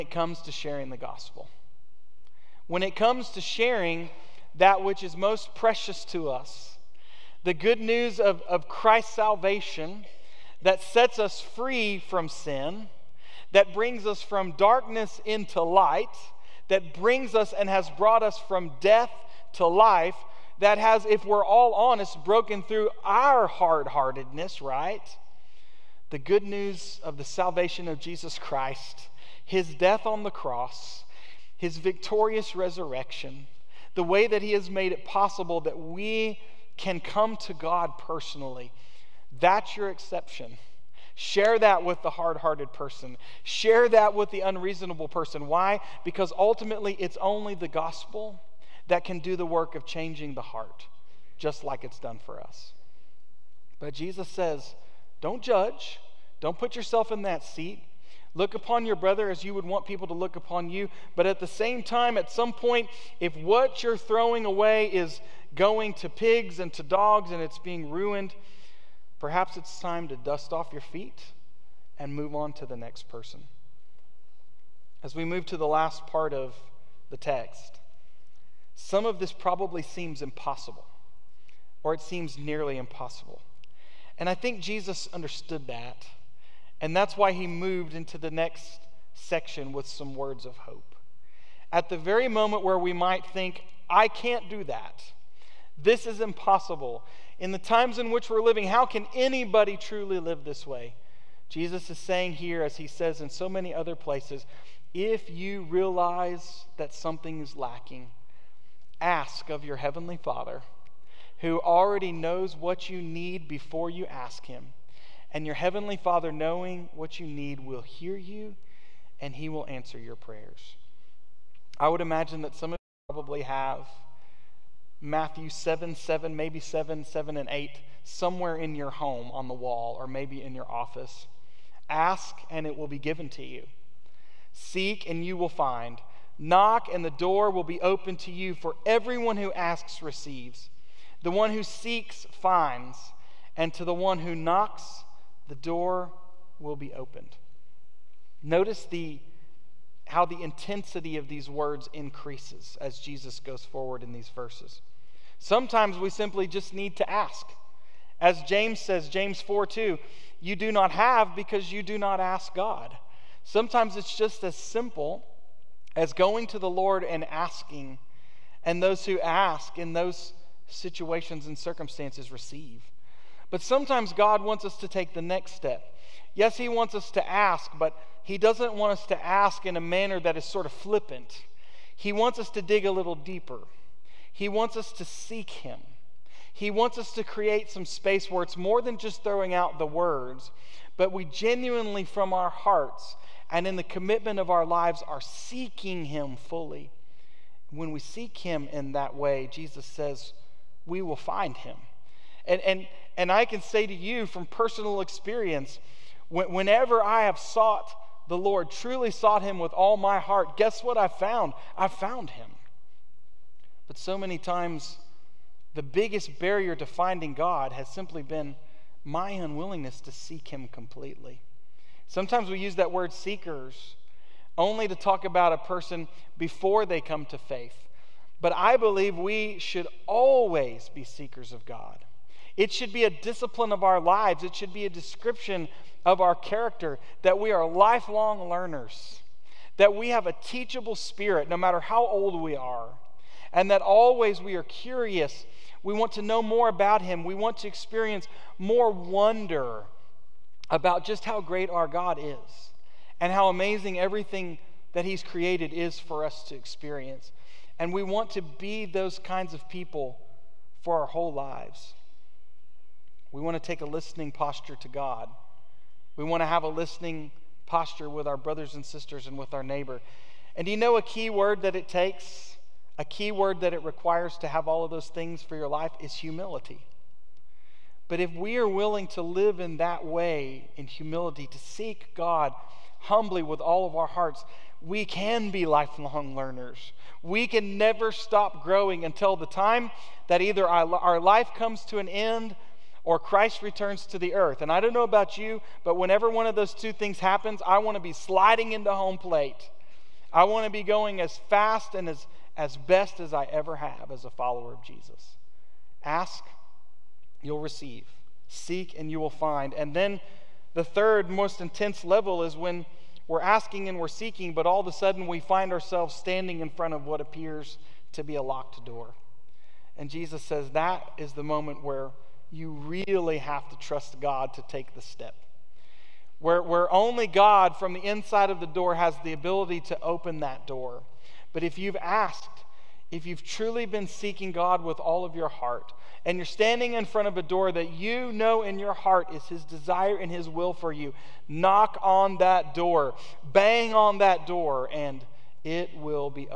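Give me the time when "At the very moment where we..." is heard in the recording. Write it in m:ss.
1:31.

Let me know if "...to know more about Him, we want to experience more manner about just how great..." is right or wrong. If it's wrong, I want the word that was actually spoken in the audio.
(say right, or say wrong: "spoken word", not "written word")
wrong: "wonder", not "manner".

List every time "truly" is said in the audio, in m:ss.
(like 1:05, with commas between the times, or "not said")
1:39, 3:28, 5:33.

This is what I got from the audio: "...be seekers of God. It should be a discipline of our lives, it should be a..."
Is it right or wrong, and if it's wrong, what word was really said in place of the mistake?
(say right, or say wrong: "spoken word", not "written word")
right.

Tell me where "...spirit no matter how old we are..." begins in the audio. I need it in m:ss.
4:00.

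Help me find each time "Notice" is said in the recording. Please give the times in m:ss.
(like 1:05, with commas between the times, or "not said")
2:28.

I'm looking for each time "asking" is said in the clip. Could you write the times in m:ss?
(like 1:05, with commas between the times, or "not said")
2:47, 5:13.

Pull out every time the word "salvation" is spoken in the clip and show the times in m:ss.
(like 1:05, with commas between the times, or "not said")
0:09, 0:27.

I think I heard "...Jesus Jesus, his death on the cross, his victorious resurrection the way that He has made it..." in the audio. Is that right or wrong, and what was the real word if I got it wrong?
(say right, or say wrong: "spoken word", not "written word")
wrong: "Christ", not "Jesus".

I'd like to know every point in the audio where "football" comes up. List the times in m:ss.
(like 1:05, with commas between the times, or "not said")
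not said.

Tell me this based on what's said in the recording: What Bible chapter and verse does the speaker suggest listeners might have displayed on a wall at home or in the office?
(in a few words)
Matthew 7:7.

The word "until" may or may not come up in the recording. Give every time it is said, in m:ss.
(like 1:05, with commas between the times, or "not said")
4:49.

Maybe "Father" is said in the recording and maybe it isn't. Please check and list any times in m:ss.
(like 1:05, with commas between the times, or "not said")
1:50, 1:55.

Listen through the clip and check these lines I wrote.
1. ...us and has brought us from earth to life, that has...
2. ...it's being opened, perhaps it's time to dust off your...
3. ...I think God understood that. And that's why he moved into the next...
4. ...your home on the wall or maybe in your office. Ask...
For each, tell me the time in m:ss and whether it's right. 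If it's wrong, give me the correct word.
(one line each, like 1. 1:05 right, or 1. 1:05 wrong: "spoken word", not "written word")
1. 0:17 wrong: "death", not "earth"
2. 1:07 wrong: "ruined", not "opened"
3. 1:24 wrong: "Jesus", not "God"
4. 2:08 right.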